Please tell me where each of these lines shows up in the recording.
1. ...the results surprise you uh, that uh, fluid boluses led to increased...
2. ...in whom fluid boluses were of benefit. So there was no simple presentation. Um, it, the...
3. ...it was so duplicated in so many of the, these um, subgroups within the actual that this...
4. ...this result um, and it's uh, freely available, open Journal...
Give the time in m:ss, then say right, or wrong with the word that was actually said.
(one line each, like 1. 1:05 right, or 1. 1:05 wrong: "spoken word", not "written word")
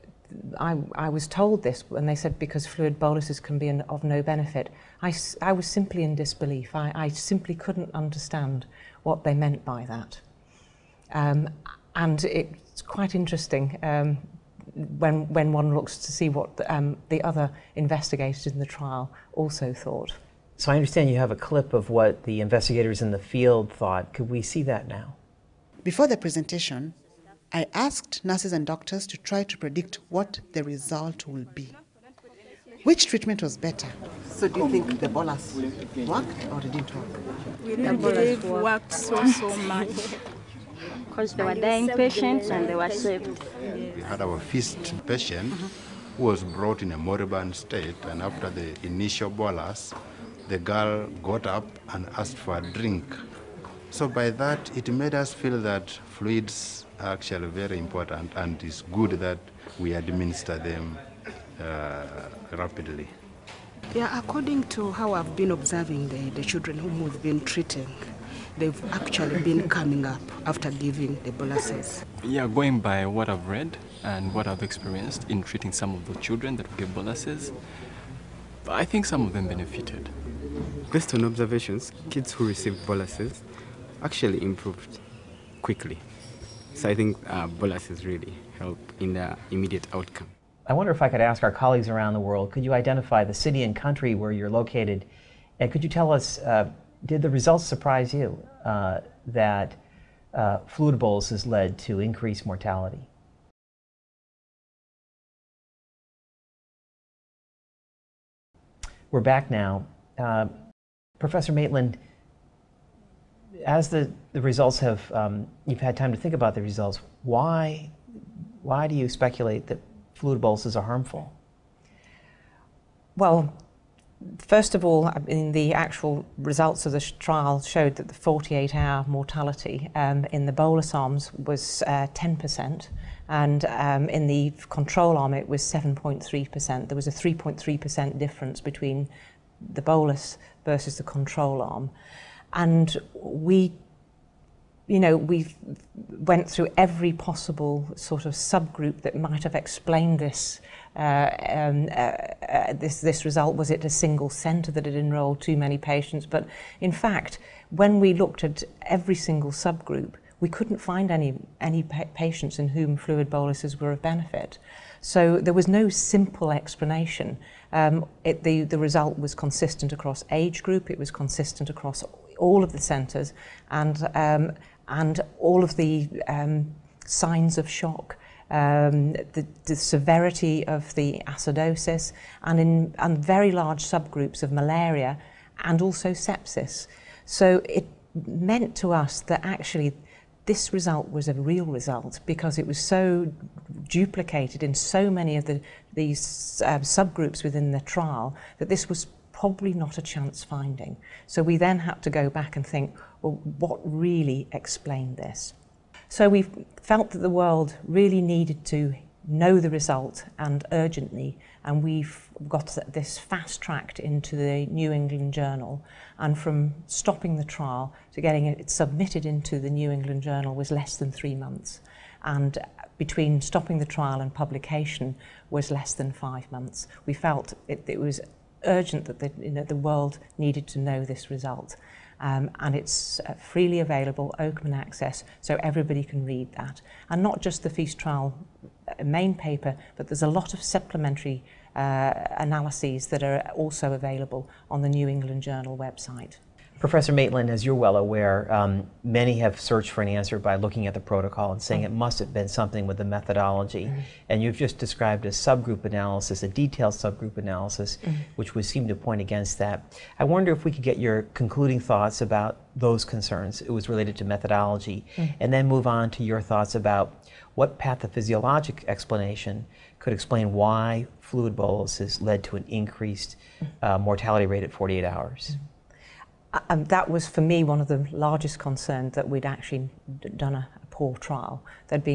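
1. 1:37 right
2. 2:42 wrong: "explanation", not "presentation"
3. 3:12 wrong: "trial", not "actual"
4. 3:51 wrong: "Access", not "Journal".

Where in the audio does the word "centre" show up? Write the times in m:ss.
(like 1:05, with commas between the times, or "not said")
2:34, 2:52.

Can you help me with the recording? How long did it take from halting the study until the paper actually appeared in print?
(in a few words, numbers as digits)
less than 5 months.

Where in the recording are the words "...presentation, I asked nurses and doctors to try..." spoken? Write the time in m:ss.
0:26.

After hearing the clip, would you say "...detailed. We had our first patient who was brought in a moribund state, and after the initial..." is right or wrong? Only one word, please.
wrong.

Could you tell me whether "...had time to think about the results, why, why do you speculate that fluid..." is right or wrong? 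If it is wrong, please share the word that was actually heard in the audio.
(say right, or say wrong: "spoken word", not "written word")
right.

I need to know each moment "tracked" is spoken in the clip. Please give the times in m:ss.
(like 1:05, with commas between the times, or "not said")
3:33.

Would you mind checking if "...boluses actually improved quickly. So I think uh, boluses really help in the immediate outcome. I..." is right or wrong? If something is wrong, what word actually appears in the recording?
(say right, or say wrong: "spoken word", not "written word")
right.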